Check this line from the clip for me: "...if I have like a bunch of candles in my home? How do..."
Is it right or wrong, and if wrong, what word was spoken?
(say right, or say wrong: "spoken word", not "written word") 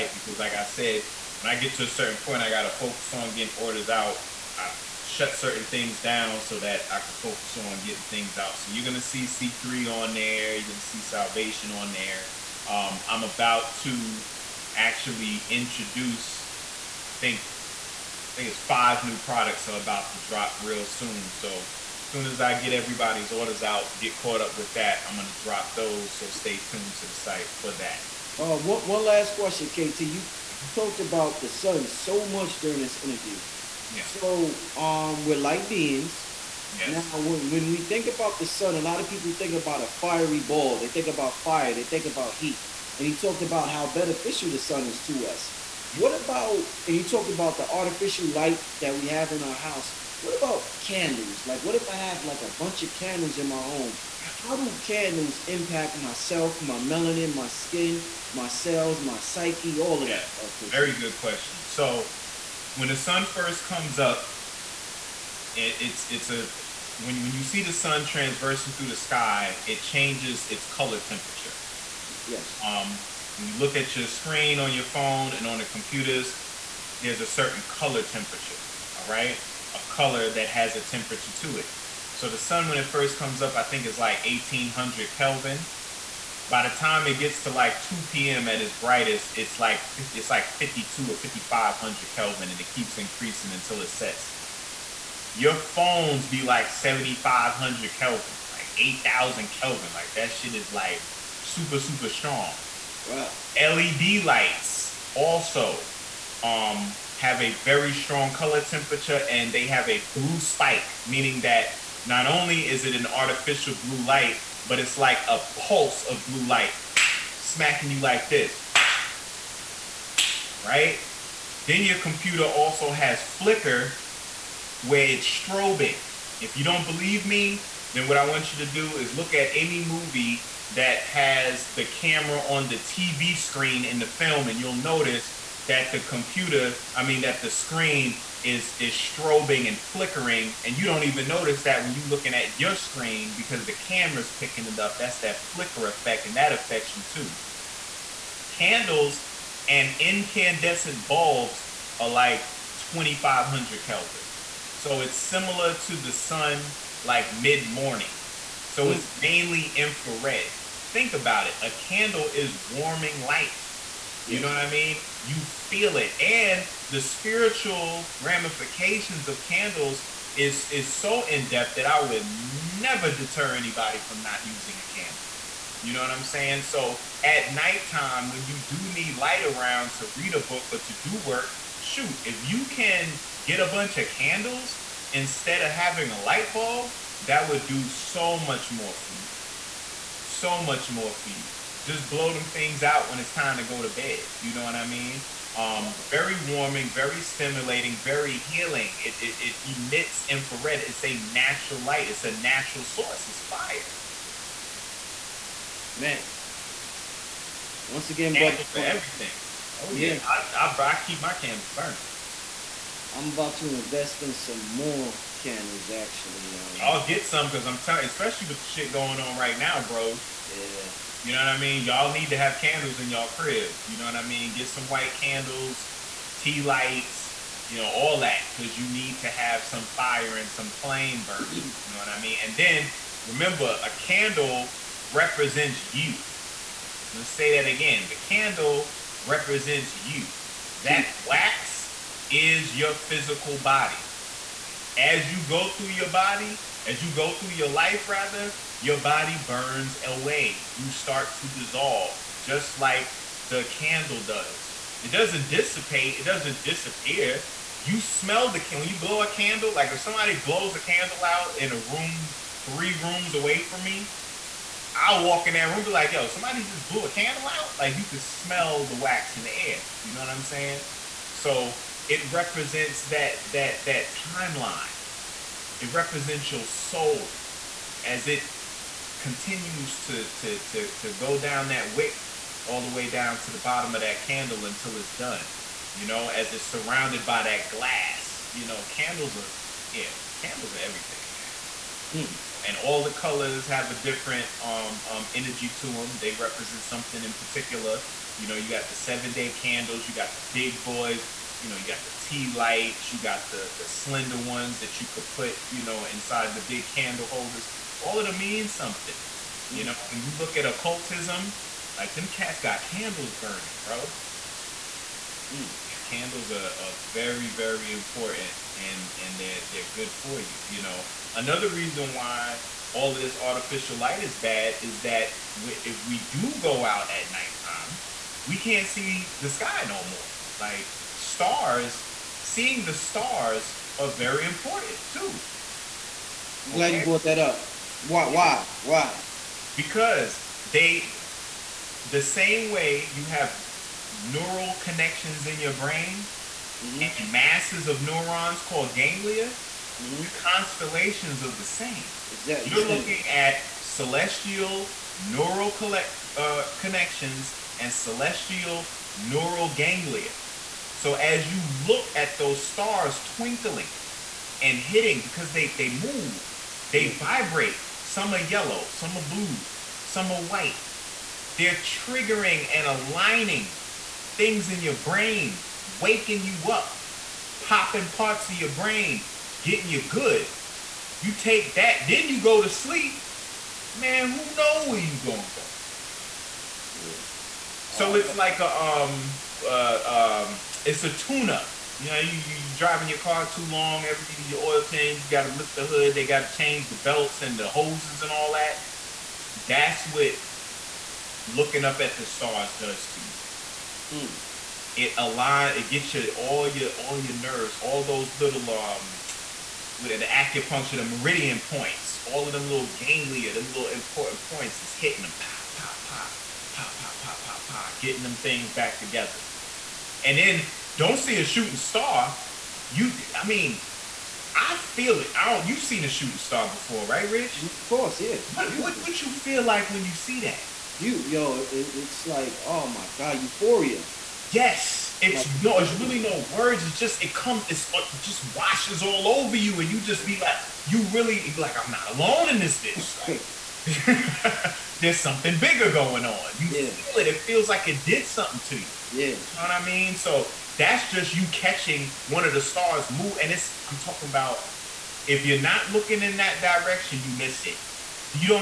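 right.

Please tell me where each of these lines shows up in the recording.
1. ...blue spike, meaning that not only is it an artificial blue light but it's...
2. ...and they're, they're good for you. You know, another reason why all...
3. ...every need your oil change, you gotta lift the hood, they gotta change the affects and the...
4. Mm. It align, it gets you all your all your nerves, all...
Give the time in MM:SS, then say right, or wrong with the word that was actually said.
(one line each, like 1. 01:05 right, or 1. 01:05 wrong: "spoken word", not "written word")
1. 01:50 right
2. 05:19 right
3. 06:34 wrong: "belts", not "affects"
4. 06:44 right.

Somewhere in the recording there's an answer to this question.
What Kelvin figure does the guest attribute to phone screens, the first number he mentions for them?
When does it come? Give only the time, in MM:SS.
01:36.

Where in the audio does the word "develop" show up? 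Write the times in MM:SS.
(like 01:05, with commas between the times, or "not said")
not said.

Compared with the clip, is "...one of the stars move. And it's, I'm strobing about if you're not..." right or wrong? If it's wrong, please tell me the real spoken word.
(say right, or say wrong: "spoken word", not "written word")
wrong: "talking", not "strobing".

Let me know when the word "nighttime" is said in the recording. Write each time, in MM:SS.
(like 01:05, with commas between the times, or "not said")
02:57, 05:27.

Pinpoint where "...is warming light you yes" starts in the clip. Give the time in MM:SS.
02:42.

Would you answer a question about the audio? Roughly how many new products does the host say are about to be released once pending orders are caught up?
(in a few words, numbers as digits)
5.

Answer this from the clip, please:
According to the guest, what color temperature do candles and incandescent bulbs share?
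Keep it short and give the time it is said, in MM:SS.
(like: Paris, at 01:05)
2500 Kelvin, at 02:32.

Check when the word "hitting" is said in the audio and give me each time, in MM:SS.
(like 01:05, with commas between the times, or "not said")
06:04, 06:54.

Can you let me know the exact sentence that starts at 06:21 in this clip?
You take that, then you go to sleep.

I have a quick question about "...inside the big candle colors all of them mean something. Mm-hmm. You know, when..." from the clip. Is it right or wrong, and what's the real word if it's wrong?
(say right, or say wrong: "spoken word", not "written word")
wrong: "holders", not "colors".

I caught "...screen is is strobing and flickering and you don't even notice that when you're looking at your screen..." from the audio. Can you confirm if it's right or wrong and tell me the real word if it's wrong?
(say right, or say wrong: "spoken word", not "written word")
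right.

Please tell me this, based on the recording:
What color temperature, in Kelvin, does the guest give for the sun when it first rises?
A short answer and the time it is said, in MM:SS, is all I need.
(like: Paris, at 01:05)
1800 Kelvin, at 01:24.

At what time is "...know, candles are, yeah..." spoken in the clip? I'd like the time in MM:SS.
04:48.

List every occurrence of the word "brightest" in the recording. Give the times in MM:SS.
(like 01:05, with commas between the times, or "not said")
01:28.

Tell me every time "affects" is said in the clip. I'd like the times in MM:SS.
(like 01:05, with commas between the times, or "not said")
02:26.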